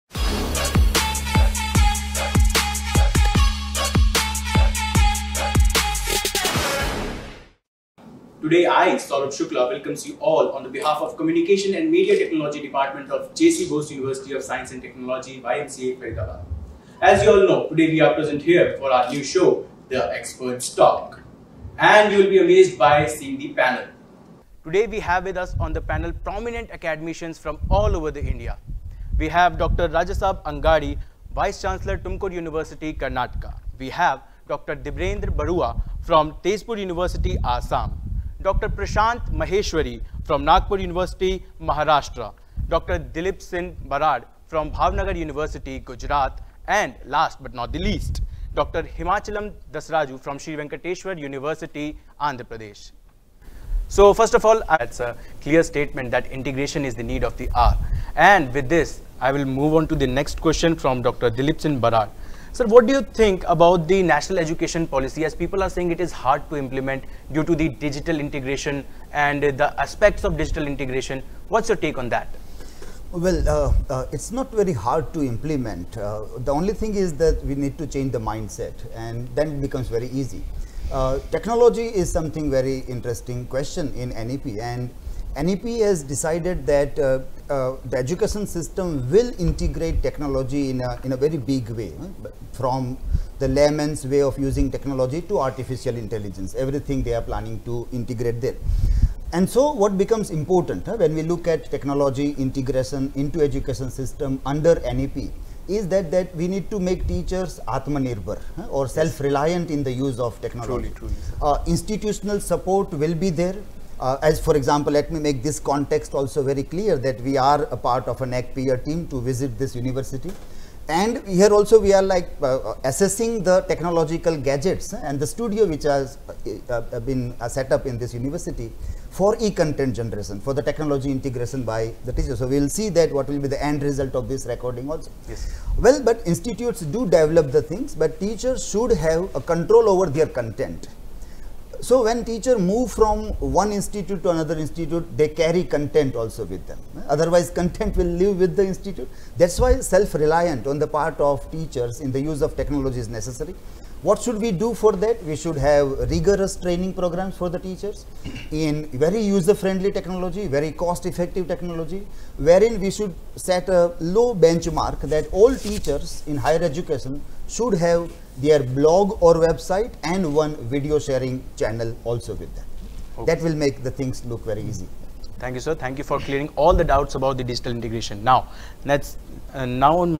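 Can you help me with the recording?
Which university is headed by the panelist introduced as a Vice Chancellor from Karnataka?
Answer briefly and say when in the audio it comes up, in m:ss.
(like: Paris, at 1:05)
Tumkur University, at 0:31.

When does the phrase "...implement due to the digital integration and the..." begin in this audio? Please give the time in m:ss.
1:06.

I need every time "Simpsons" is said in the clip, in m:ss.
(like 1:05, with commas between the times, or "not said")
not said.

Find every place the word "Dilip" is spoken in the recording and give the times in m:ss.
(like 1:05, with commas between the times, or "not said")
0:42, 1:01.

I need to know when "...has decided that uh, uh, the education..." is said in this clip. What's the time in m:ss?
1:25.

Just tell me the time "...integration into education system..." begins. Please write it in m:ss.
1:42.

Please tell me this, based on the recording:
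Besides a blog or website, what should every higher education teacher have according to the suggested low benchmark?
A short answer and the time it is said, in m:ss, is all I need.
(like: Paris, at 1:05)
video sharing channel, at 2:50.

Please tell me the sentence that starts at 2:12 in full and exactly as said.
So, we will see that what will be the end result of this recording also.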